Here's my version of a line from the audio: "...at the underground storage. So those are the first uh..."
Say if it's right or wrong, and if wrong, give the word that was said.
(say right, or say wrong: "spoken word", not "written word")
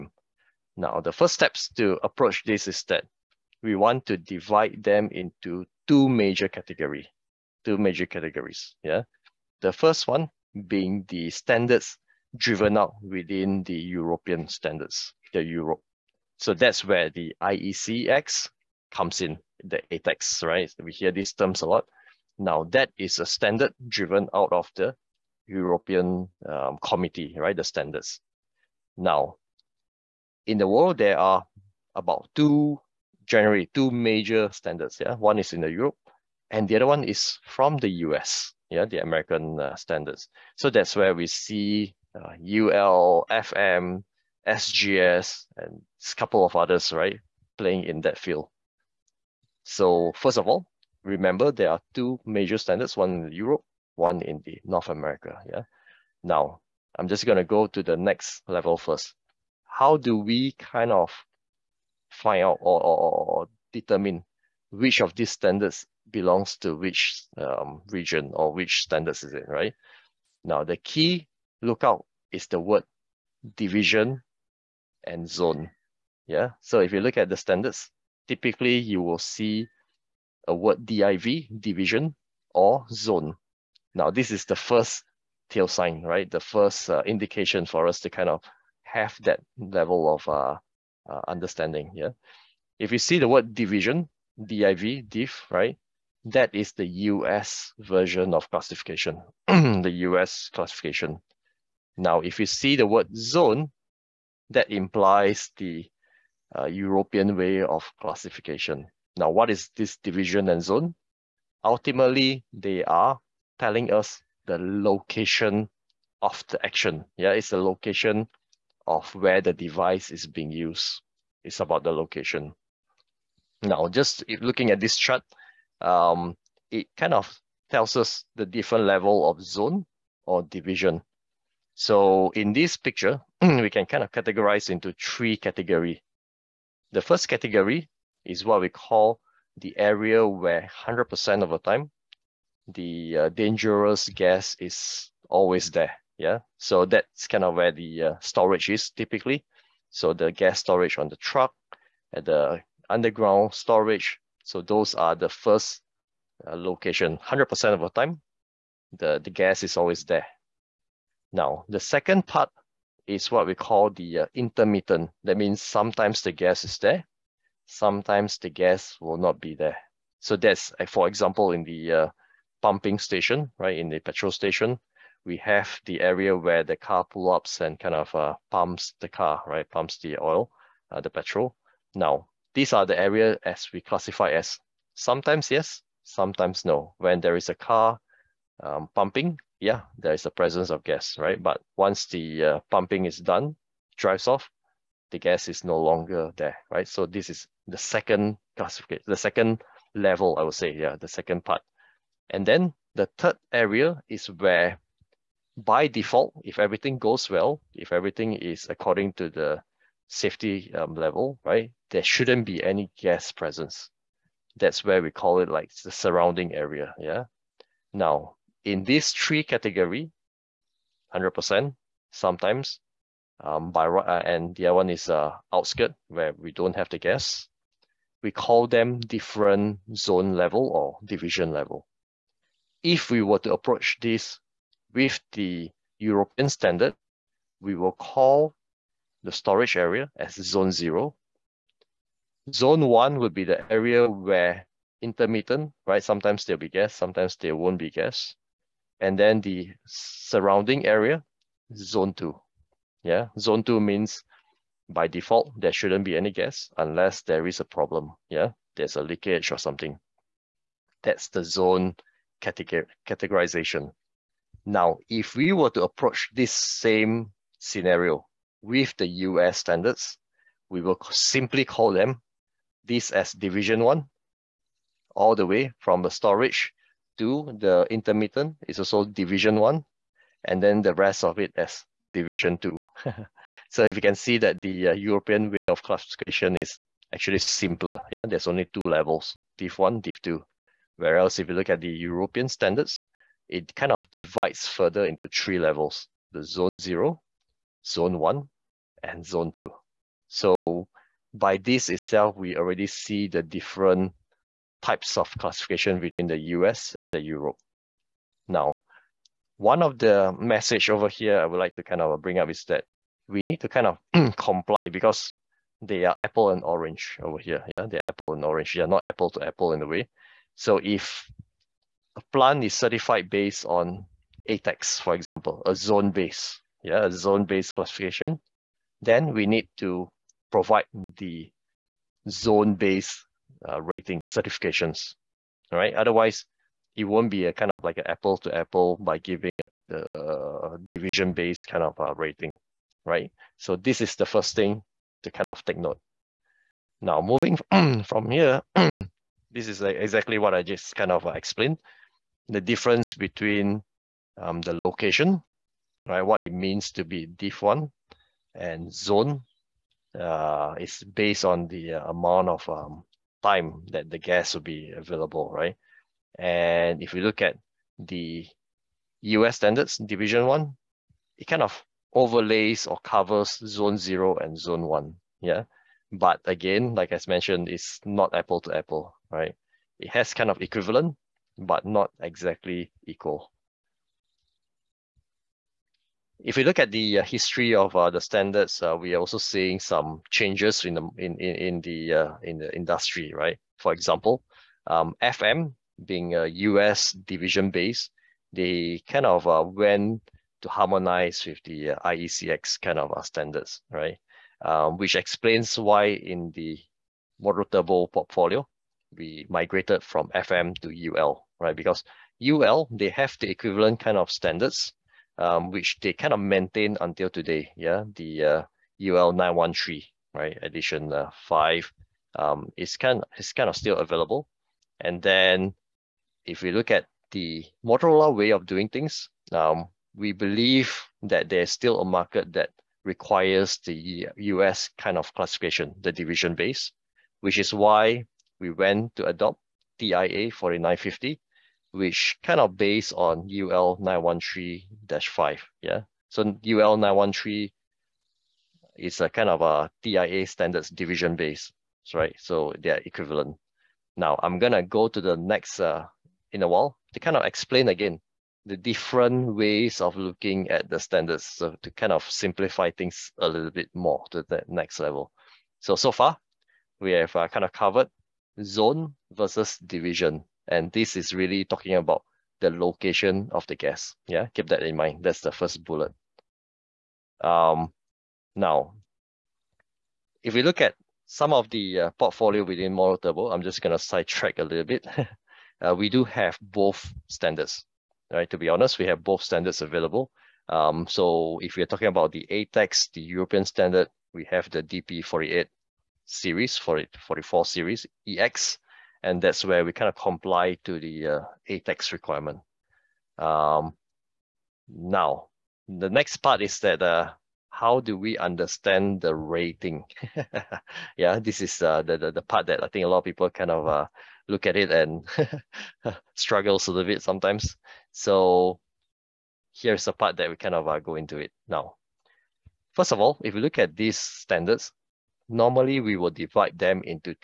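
right.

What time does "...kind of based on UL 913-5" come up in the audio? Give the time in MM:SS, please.
07:22.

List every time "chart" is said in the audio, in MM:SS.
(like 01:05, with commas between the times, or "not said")
02:04.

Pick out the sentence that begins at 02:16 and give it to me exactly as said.
The first category is what we call the area where 100% of the time, the uh, dangerous gas is always there.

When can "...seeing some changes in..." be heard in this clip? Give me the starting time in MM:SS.
06:29.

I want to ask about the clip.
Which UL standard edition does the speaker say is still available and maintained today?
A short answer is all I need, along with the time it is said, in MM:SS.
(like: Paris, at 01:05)
UL 913 edition 5, at 06:59.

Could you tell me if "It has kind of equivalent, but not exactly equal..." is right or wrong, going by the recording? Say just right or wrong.
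right.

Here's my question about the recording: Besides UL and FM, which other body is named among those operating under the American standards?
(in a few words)
SGS.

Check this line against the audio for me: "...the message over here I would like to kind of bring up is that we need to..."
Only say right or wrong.
right.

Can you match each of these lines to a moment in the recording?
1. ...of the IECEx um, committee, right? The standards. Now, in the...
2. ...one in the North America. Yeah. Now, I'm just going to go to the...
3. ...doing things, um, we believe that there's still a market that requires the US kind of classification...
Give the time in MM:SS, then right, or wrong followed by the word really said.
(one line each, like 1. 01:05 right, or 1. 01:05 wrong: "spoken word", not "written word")
1. 00:24 wrong: "European", not "IECEx"
2. 00:53 right
3. 07:08 right.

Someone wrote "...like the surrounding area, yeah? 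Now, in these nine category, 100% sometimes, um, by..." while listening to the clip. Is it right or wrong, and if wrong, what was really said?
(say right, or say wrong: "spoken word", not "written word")
wrong: "three", not "nine".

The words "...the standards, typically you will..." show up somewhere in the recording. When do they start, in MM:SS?
01:17.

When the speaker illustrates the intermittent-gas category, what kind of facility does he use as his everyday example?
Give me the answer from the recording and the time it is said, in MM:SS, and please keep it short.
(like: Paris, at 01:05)
Petrol station, at 02:53.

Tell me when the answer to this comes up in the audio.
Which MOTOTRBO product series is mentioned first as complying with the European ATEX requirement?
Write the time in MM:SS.
08:14.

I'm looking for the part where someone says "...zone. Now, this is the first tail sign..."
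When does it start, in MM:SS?
01:22.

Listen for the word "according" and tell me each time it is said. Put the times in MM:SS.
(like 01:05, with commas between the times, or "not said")
03:28.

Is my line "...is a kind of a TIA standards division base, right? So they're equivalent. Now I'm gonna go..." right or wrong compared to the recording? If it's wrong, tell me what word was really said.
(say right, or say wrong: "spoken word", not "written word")
right.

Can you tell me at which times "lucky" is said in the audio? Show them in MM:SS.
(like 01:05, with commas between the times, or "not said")
not said.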